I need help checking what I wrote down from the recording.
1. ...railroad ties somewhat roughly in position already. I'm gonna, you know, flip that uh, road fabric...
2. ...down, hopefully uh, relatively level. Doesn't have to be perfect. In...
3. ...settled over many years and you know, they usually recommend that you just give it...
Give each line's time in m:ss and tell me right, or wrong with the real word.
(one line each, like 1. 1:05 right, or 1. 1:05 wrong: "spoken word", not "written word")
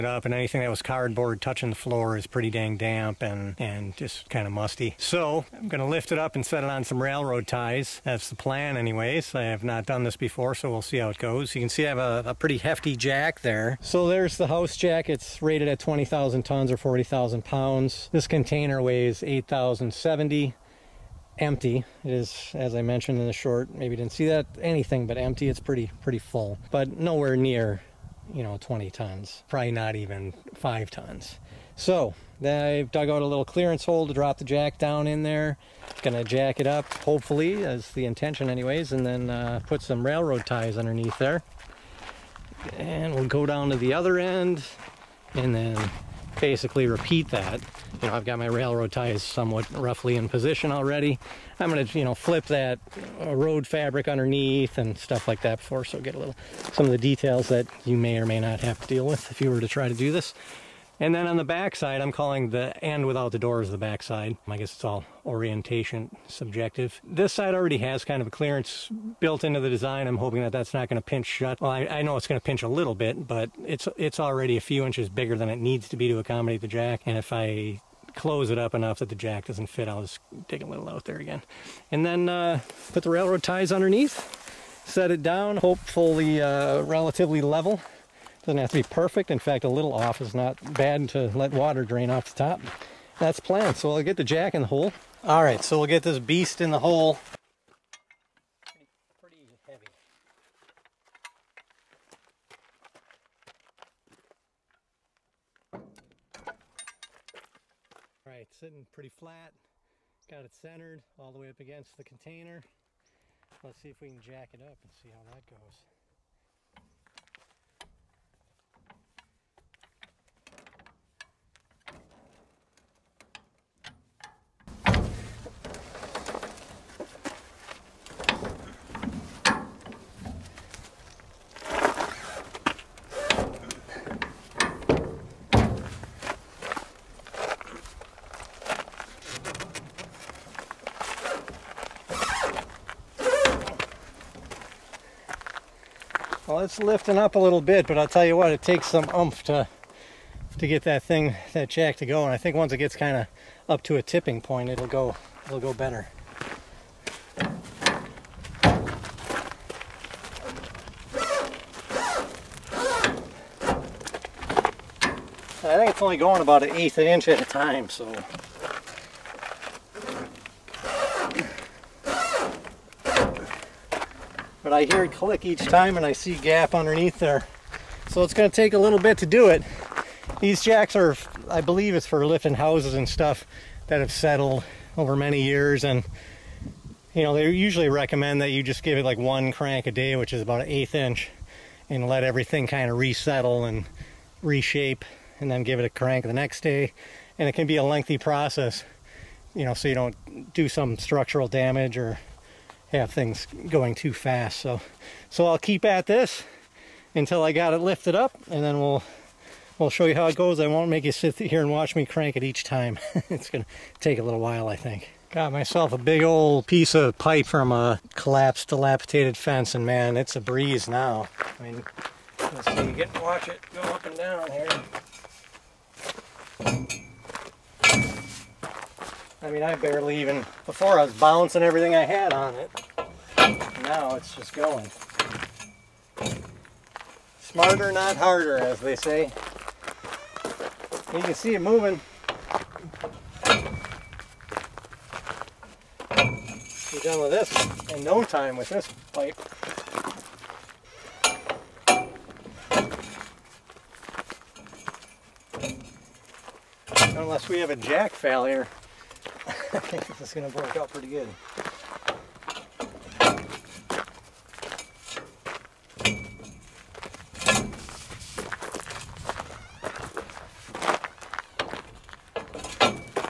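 1. 0:48 right
2. 1:25 right
3. 3:04 right.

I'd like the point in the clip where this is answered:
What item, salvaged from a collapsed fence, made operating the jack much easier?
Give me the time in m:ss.
3:36.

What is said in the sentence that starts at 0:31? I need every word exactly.
So I've dug out a little clearance hole to drop the jack down in there.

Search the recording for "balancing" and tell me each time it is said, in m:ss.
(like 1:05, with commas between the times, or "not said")
3:51.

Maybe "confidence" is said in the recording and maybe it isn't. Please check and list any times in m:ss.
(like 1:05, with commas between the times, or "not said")
not said.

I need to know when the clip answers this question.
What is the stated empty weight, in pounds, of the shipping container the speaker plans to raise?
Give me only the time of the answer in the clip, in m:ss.
0:19.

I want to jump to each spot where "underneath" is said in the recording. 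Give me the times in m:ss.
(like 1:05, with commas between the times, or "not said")
0:40, 0:54, 1:23, 2:56.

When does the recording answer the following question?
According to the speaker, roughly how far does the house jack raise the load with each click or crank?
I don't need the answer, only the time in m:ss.
2:46.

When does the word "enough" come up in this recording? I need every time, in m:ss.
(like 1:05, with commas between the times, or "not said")
1:18.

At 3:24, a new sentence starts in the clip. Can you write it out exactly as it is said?
So, so I'll keep at this until I got it lifted up, and then we'll we'll show you how it goes.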